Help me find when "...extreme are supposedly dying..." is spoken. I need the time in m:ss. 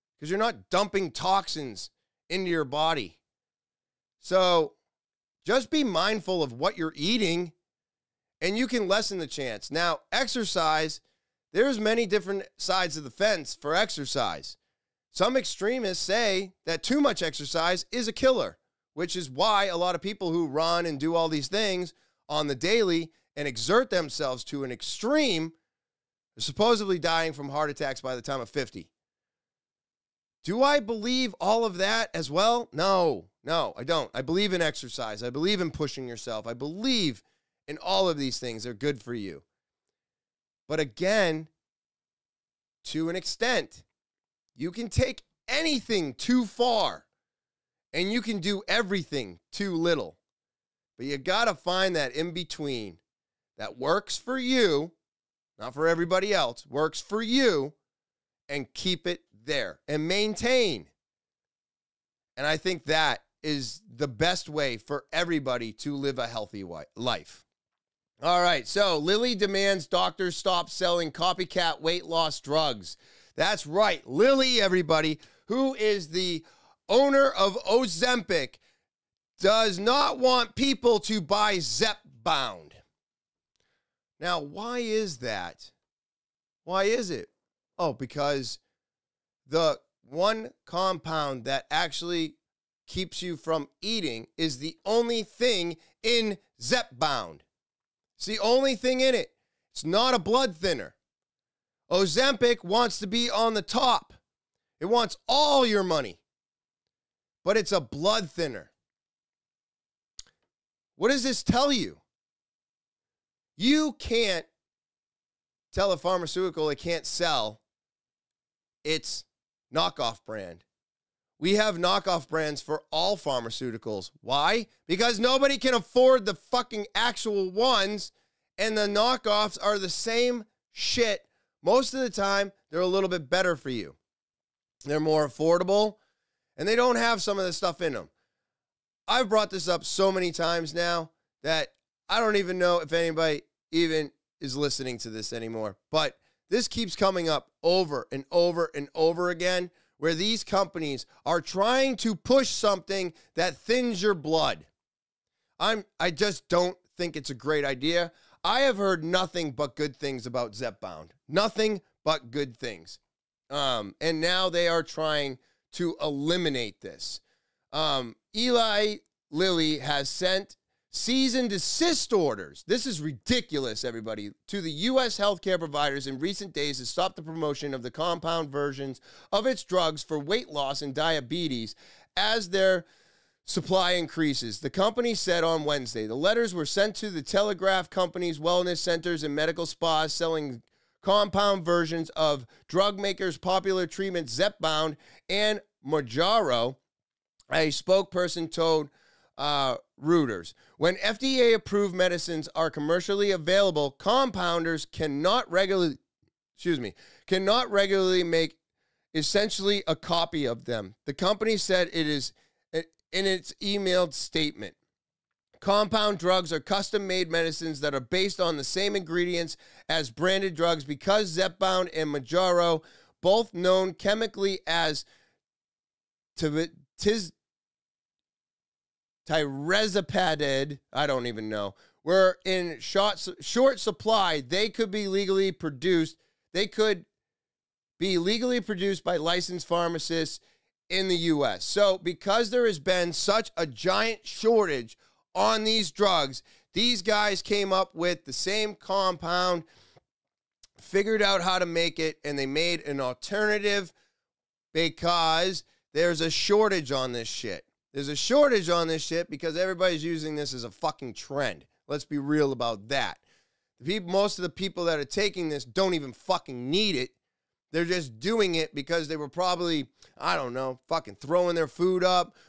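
0:24.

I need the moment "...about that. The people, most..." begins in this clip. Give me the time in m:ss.
4:22.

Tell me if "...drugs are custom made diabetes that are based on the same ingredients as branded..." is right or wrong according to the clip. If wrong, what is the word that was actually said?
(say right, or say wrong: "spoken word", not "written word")
wrong: "medicines", not "diabetes".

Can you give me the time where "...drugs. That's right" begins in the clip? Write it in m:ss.
1:12.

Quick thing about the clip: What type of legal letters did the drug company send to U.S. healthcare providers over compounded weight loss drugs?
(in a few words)
cease and desist orders.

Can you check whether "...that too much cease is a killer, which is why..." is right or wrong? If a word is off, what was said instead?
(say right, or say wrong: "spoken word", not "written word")
wrong: "exercise", not "cease".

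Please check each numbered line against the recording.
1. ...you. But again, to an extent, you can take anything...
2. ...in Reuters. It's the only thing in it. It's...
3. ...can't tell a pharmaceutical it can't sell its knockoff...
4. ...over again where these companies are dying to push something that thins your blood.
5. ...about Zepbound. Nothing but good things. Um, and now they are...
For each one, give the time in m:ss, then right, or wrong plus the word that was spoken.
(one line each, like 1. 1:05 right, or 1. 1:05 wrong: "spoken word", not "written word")
1. 0:39 right
2. 1:36 wrong: "Zepbound", not "Reuters"
3. 1:53 right
4. 2:28 wrong: "trying", not "dying"
5. 2:40 right.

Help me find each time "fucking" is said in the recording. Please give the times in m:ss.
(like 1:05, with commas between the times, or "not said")
2:06, 4:20, 4:26, 4:30.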